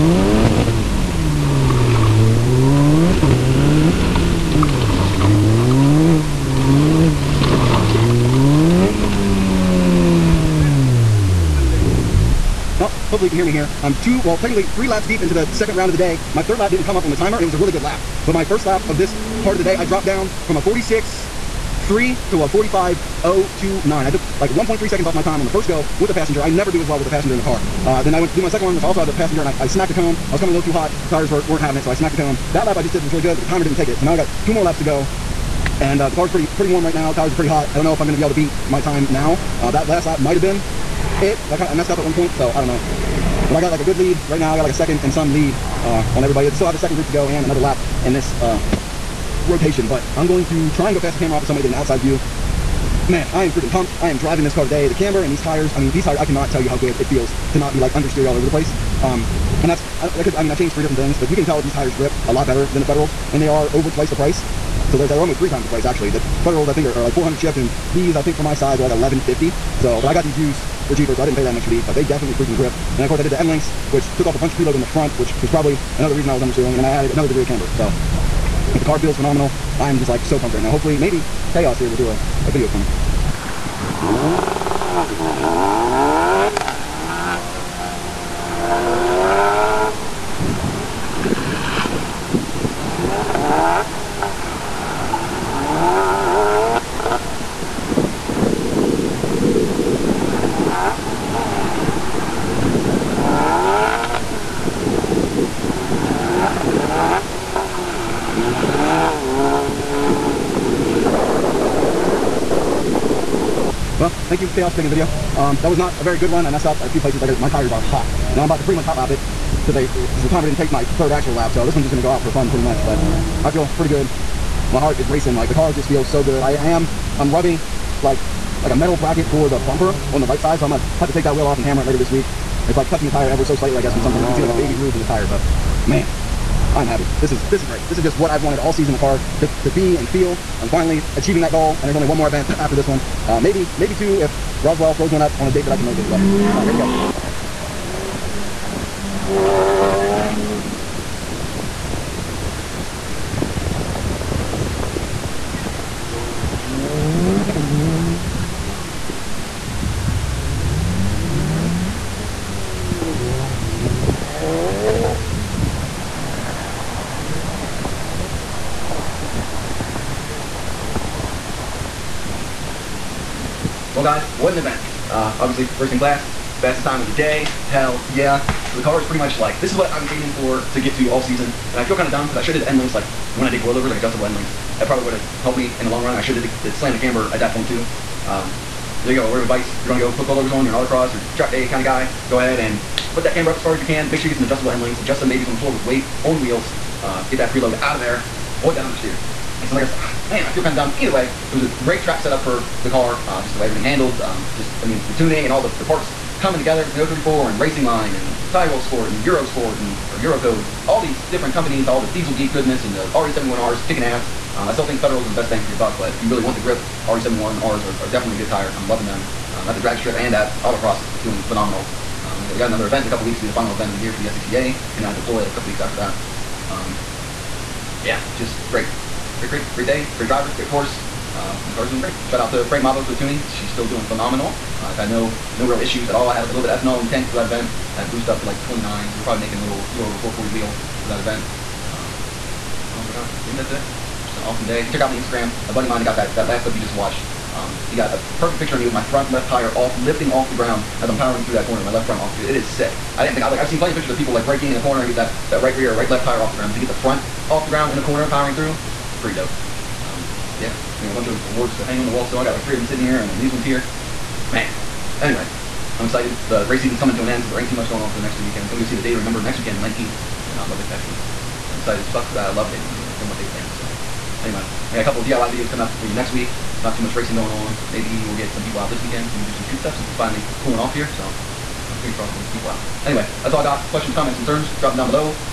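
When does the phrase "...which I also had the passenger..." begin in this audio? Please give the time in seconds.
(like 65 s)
28 s.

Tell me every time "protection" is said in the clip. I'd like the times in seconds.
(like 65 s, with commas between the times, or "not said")
not said.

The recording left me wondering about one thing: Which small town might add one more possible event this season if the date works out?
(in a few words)
Roswell.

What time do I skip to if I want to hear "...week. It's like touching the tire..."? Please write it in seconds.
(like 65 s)
132 s.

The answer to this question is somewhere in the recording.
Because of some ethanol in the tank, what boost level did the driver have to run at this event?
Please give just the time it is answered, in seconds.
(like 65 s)
238 s.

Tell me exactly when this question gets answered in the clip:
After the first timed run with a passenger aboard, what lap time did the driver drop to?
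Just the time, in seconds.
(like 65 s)
22 s.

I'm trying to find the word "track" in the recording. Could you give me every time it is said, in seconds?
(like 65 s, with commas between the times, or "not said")
191 s, 202 s.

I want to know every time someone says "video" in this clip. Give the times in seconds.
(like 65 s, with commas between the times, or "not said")
82 s, 114 s, 275 s.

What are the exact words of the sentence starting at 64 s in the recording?
So there's they're almost three times the price actually.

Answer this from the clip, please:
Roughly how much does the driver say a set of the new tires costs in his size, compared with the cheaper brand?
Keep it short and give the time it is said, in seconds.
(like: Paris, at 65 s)
1150, at 68 s.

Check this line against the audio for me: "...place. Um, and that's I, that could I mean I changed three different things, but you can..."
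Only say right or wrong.
right.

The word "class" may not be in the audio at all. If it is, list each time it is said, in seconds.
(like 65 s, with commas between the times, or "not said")
175 s.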